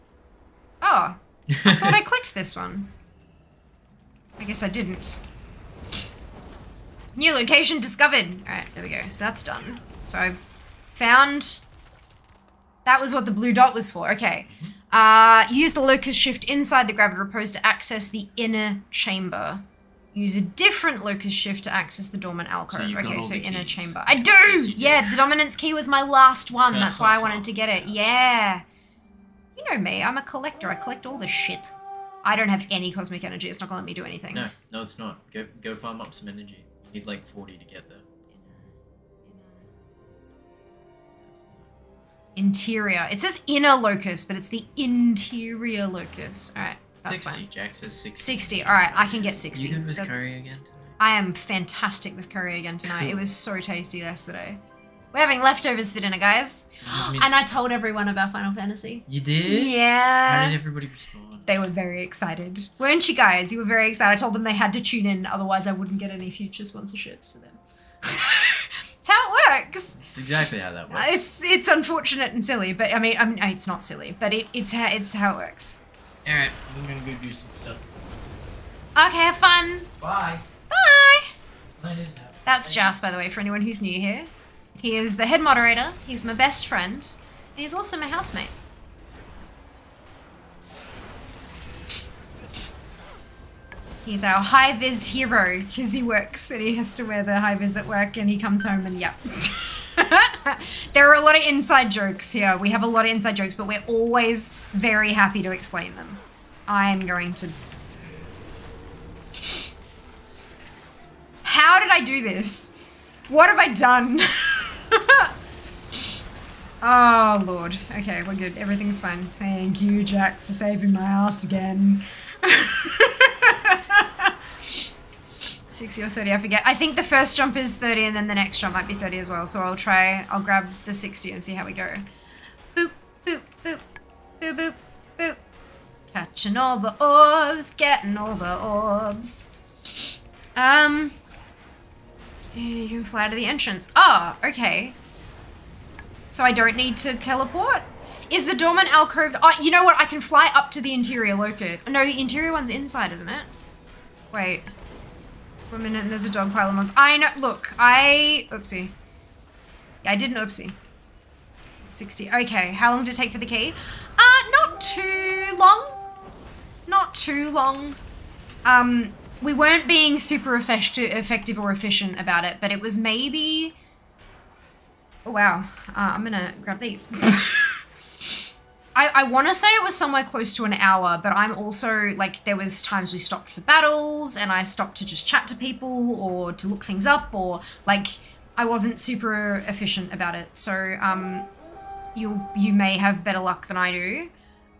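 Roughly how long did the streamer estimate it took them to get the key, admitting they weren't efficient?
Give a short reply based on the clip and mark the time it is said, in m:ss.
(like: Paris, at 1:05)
Close to an hour, at 3:00.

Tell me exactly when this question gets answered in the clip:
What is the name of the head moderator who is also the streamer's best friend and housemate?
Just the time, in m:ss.
1:22.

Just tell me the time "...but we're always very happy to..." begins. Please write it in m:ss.
1:43.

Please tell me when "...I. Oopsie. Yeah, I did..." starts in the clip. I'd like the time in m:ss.
2:37.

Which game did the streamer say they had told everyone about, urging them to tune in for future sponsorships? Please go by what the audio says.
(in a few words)
Final Fantasy.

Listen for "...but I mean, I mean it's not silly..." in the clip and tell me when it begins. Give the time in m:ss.
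1:12.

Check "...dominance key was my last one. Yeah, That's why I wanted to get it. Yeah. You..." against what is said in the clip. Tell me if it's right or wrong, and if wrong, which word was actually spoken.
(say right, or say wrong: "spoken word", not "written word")
right.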